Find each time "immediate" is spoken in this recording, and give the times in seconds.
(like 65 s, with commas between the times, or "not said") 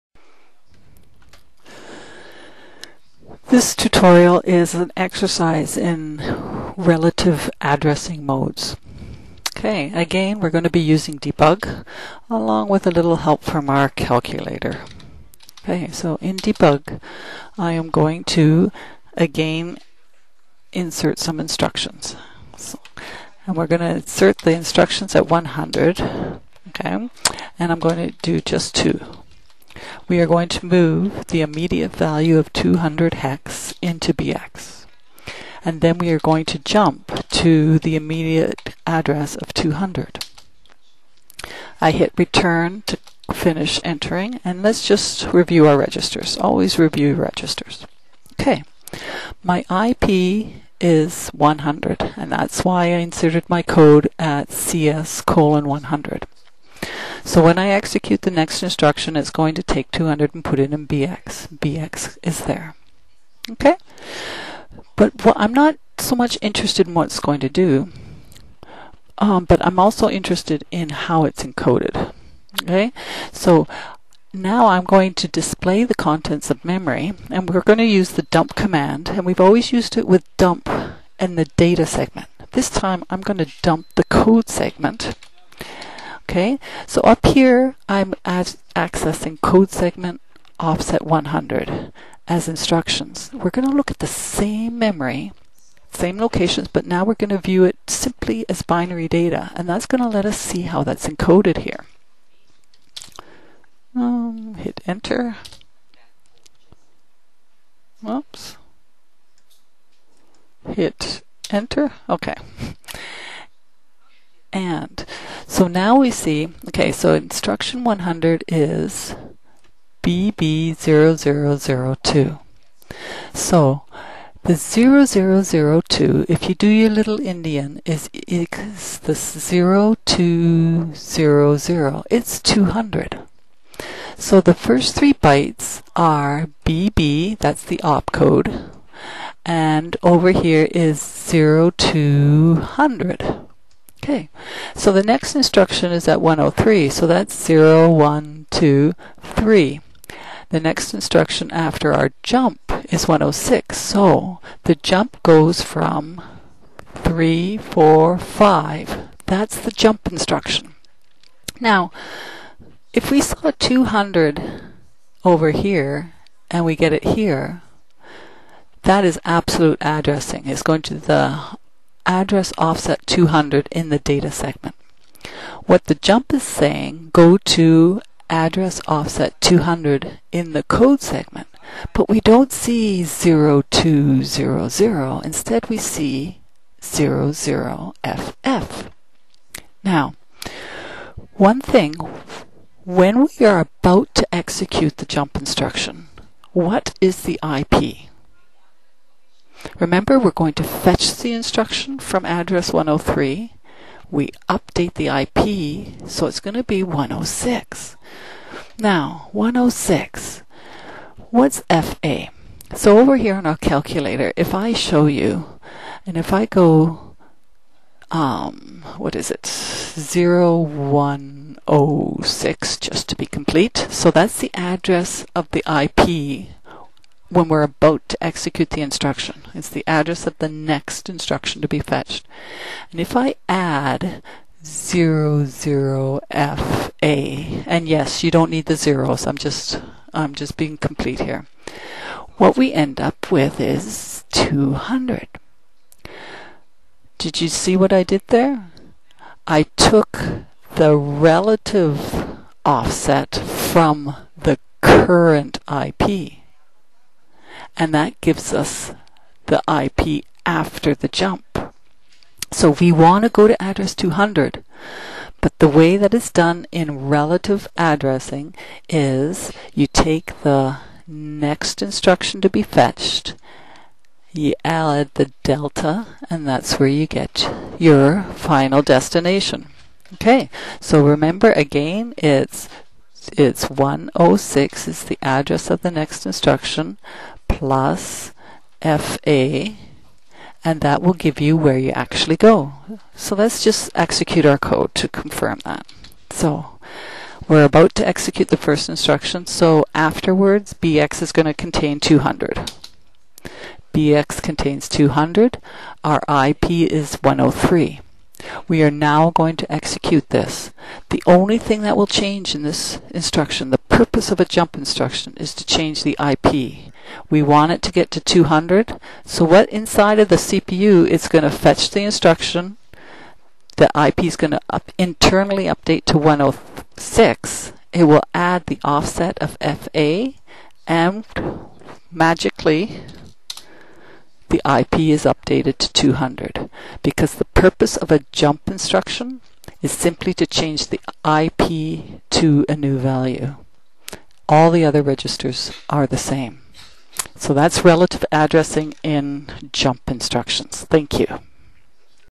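31 s, 37 s.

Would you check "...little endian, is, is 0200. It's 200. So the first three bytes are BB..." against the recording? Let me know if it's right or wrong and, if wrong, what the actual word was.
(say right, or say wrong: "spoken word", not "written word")
right.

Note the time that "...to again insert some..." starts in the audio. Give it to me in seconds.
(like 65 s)
18 s.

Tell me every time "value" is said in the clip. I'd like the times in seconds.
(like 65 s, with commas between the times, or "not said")
31 s, 342 s.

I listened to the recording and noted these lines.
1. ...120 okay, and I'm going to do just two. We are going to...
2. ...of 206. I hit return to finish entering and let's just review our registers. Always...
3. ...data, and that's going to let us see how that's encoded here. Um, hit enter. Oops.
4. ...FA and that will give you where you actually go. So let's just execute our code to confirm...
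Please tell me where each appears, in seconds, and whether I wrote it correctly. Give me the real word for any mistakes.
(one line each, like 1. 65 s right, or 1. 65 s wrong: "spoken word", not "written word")
1. 25 s wrong: "100", not "120"
2. 39 s wrong: "200", not "206"
3. 99 s right
4. 288 s right.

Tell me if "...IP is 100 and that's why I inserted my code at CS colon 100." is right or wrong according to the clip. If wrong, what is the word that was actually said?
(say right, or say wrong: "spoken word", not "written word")
right.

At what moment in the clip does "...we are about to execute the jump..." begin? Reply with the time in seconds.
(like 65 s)
193 s.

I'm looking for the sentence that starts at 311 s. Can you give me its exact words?
The only thing that will change in this instruction, the purpose of a jump instruction is to change the IP.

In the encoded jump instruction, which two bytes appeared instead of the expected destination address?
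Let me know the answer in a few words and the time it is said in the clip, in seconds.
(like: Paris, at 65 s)
00FF, at 186 s.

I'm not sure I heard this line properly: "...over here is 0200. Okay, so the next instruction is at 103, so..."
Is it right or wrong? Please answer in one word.
right.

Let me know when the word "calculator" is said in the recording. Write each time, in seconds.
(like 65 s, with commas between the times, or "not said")
13 s, 213 s.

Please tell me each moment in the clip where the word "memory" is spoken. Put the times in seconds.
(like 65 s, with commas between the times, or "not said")
76 s, 94 s.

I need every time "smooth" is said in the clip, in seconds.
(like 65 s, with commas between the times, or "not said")
not said.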